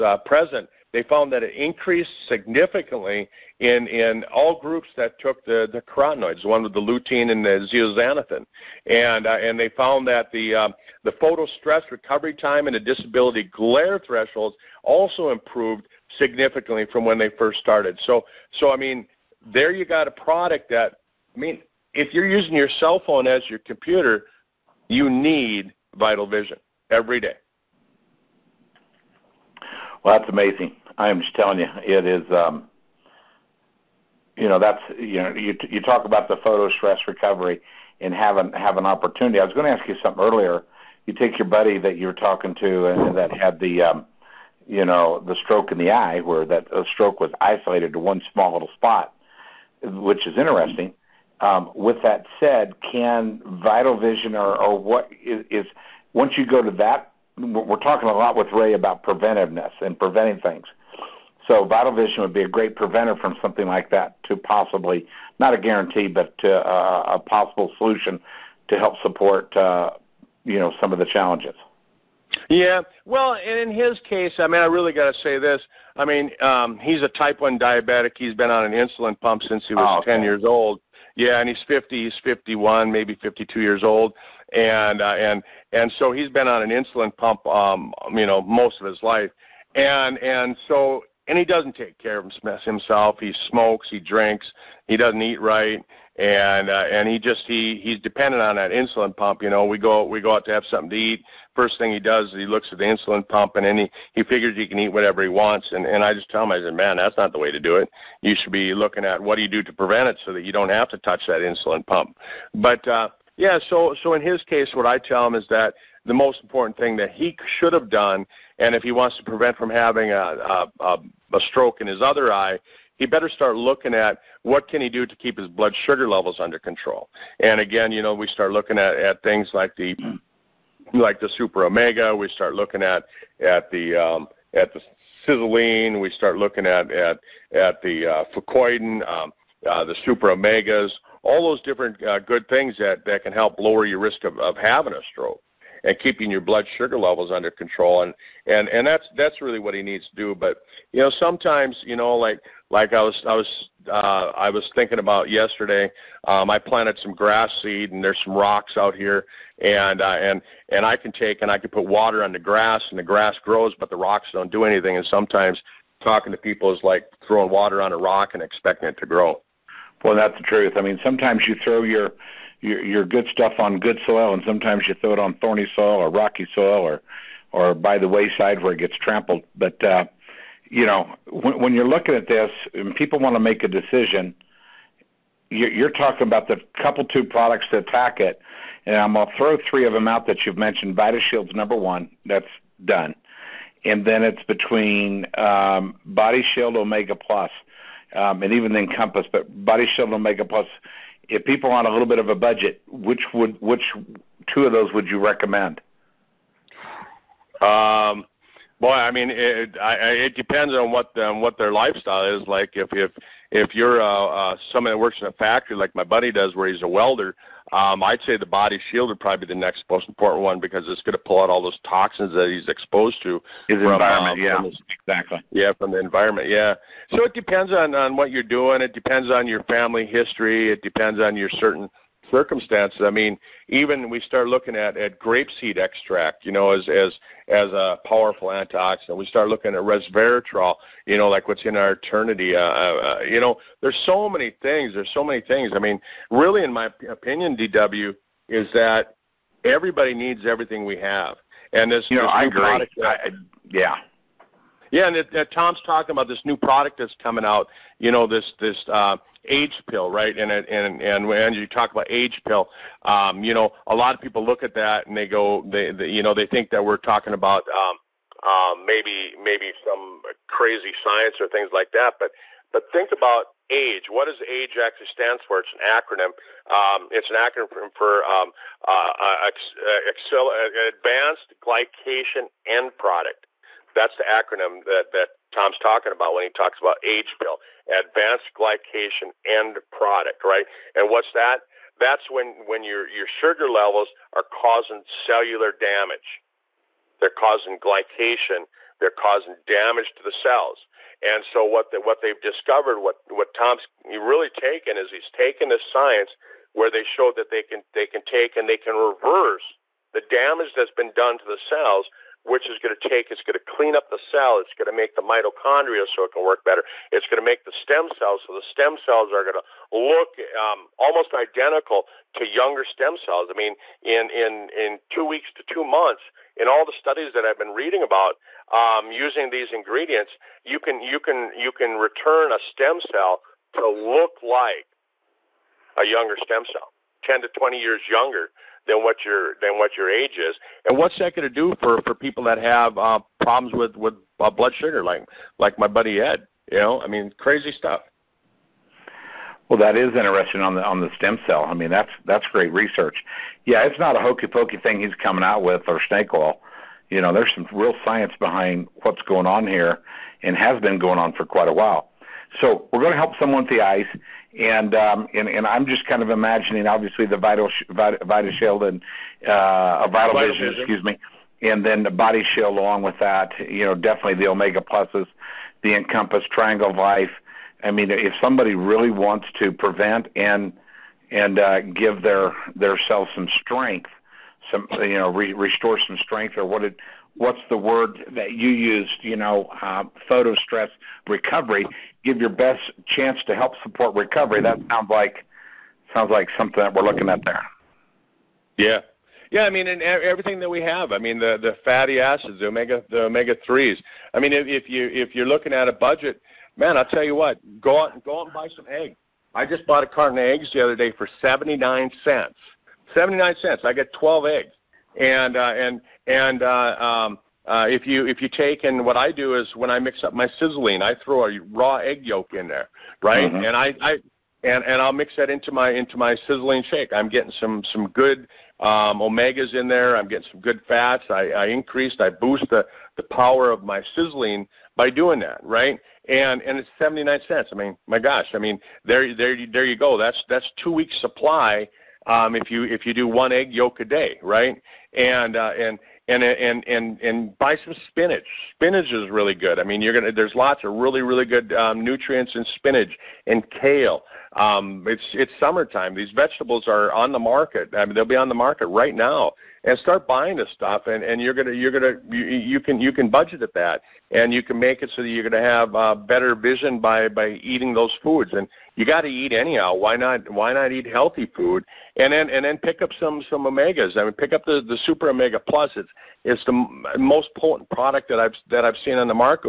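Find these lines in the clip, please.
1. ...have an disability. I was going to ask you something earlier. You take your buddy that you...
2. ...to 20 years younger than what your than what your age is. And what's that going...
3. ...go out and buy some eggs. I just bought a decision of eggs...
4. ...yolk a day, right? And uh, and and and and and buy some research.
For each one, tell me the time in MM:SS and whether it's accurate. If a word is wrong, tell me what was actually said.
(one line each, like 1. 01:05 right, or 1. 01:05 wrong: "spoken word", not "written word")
1. 00:38 wrong: "opportunity", not "disability"
2. 05:37 right
3. 06:48 wrong: "carton", not "decision"
4. 07:23 wrong: "spinach", not "research".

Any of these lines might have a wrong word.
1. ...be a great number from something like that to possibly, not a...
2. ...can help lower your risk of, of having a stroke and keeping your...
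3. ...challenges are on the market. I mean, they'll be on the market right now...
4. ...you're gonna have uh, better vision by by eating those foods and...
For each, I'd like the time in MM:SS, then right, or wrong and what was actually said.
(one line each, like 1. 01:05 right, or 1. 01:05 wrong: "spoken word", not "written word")
1. 01:02 wrong: "preventer", not "number"
2. 02:23 right
3. 07:36 wrong: "vegetables", not "challenges"
4. 07:45 right.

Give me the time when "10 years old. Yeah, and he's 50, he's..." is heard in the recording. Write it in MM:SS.
01:20.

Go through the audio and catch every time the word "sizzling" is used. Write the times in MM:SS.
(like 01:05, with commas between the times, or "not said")
02:15, 07:00, 07:06, 07:14.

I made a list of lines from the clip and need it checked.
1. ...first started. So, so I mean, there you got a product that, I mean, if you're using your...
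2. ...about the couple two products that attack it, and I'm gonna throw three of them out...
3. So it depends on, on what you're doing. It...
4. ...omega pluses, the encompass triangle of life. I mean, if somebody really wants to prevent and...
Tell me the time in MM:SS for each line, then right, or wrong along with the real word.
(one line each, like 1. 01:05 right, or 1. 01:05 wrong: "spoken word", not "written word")
1. 00:17 right
2. 03:06 right
3. 03:47 right
4. 06:14 right.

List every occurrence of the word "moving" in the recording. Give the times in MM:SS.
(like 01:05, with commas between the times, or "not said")
not said.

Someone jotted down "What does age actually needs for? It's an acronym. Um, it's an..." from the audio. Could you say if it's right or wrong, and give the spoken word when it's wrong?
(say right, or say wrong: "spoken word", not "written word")
wrong: "stands", not "needs".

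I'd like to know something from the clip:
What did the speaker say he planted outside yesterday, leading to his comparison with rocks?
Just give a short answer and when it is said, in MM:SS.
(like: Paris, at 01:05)
grass seed, at 02:37.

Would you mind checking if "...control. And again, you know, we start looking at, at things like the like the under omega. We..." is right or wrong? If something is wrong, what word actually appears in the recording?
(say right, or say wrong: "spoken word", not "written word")
wrong: "super", not "under".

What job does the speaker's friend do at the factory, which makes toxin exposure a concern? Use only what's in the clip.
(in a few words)
welder.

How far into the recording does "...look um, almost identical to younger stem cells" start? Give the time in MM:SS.
05:19.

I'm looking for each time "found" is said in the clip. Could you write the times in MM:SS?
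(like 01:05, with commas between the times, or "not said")
00:01, 00:09.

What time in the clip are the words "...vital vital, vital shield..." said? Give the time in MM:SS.
06:07.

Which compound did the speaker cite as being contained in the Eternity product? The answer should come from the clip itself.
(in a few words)
resveratrol.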